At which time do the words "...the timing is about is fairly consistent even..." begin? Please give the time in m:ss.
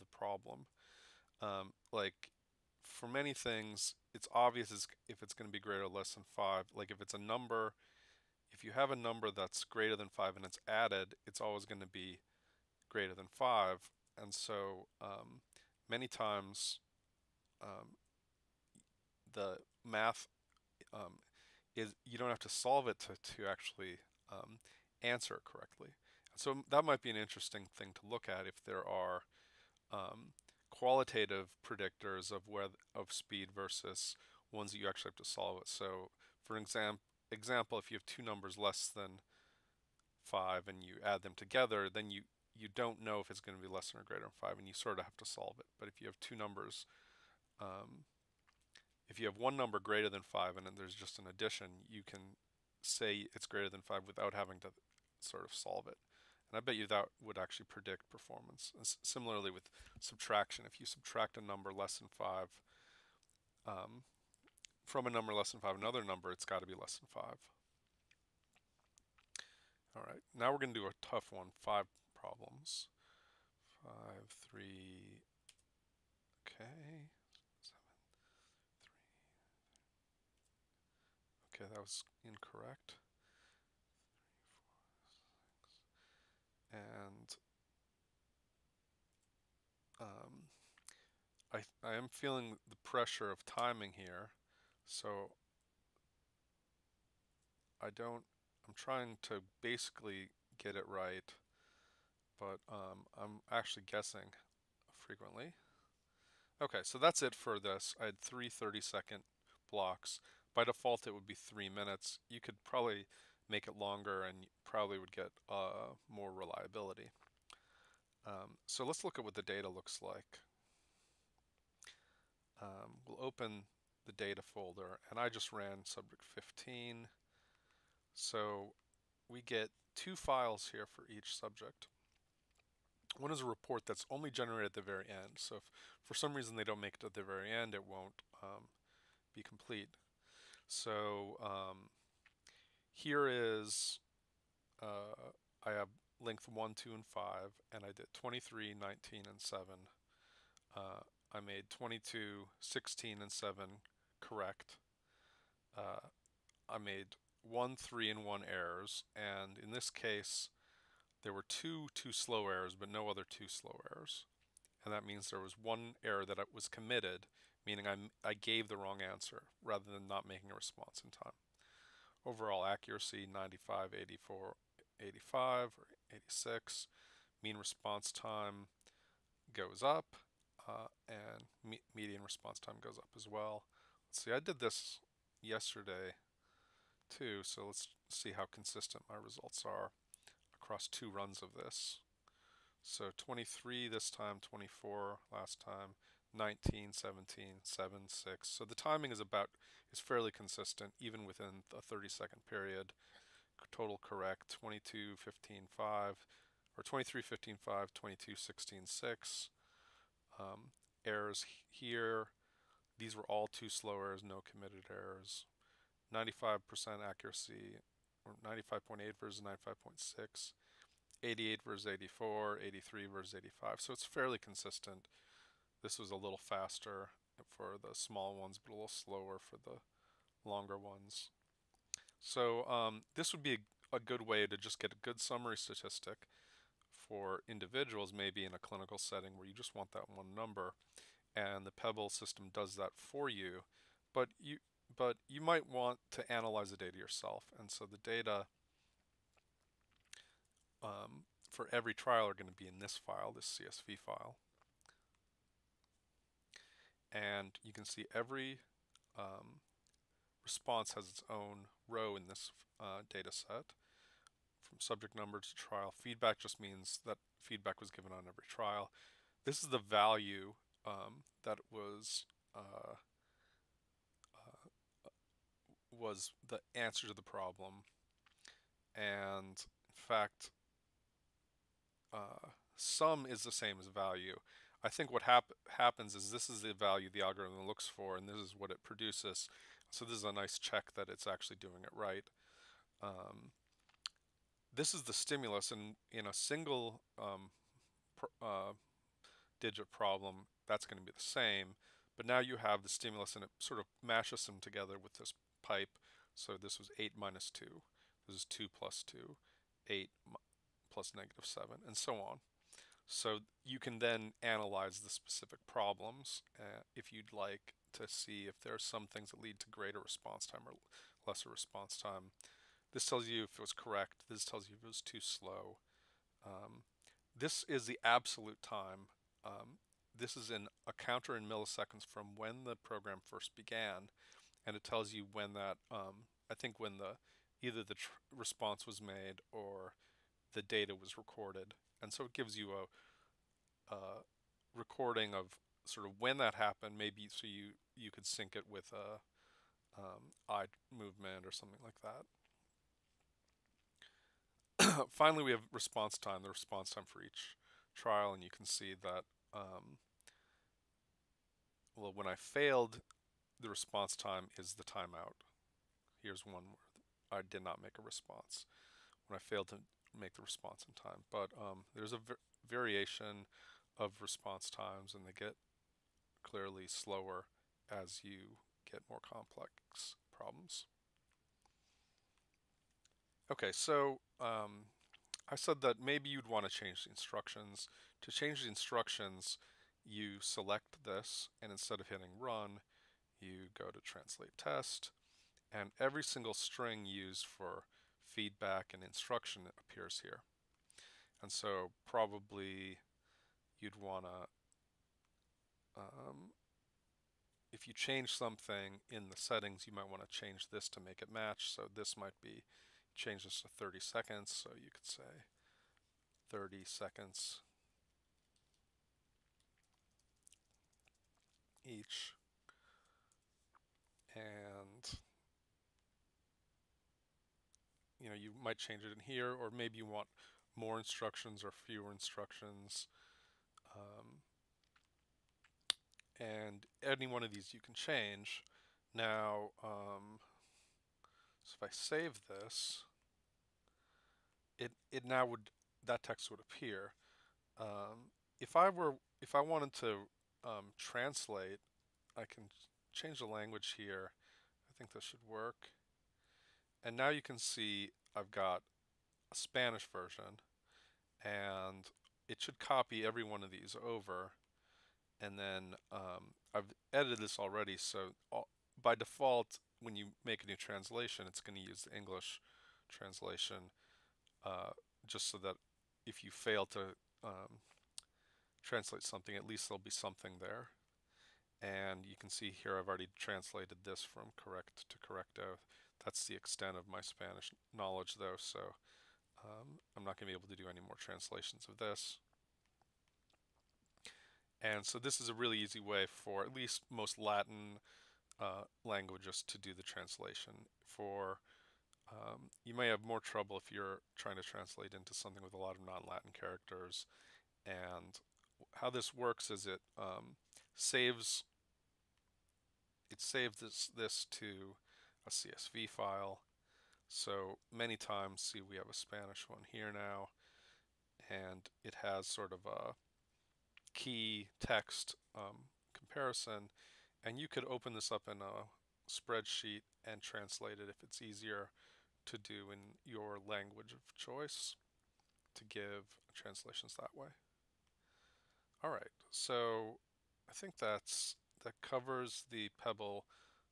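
3:18.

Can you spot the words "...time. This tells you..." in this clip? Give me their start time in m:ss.
5:21.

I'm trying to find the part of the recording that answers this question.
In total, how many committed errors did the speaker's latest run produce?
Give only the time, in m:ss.
2:45.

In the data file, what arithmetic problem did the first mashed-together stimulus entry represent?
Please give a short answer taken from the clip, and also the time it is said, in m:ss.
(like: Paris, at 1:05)
8 minus 2, at 5:06.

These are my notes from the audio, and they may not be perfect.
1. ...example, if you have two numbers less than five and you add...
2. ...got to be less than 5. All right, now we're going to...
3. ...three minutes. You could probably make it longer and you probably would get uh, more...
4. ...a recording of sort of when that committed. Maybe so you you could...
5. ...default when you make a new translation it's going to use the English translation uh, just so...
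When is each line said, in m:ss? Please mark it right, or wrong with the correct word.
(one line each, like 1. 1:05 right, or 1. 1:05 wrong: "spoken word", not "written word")
1. 0:37 right
2. 1:06 right
3. 1:51 right
4. 5:43 wrong: "happened", not "committed"
5. 7:49 right.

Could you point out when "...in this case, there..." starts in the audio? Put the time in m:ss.
2:39.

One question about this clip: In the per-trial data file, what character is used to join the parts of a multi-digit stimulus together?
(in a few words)
pipe.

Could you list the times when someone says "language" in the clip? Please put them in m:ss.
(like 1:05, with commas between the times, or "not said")
7:33, 8:19, 8:53.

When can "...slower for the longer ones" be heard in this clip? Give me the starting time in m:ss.
3:48.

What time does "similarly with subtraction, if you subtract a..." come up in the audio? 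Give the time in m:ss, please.
0:59.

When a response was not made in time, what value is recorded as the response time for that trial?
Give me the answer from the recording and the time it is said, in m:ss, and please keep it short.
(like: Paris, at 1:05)
the timeout, at 6:04.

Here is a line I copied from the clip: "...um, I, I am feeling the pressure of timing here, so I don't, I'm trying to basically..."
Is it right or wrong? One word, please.
right.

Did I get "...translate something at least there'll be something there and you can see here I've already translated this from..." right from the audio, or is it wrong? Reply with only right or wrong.
right.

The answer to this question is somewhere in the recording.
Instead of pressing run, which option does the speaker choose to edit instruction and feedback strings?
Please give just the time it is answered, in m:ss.
6:34.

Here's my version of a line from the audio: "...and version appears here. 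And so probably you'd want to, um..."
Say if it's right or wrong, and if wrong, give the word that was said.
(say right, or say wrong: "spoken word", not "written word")
wrong: "instruction", not "version".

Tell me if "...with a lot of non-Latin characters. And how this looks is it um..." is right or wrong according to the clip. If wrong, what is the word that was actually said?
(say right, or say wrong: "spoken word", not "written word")
wrong: "works", not "looks".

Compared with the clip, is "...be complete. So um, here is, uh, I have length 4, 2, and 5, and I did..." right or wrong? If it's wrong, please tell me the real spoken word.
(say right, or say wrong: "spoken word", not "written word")
wrong: "1", not "4".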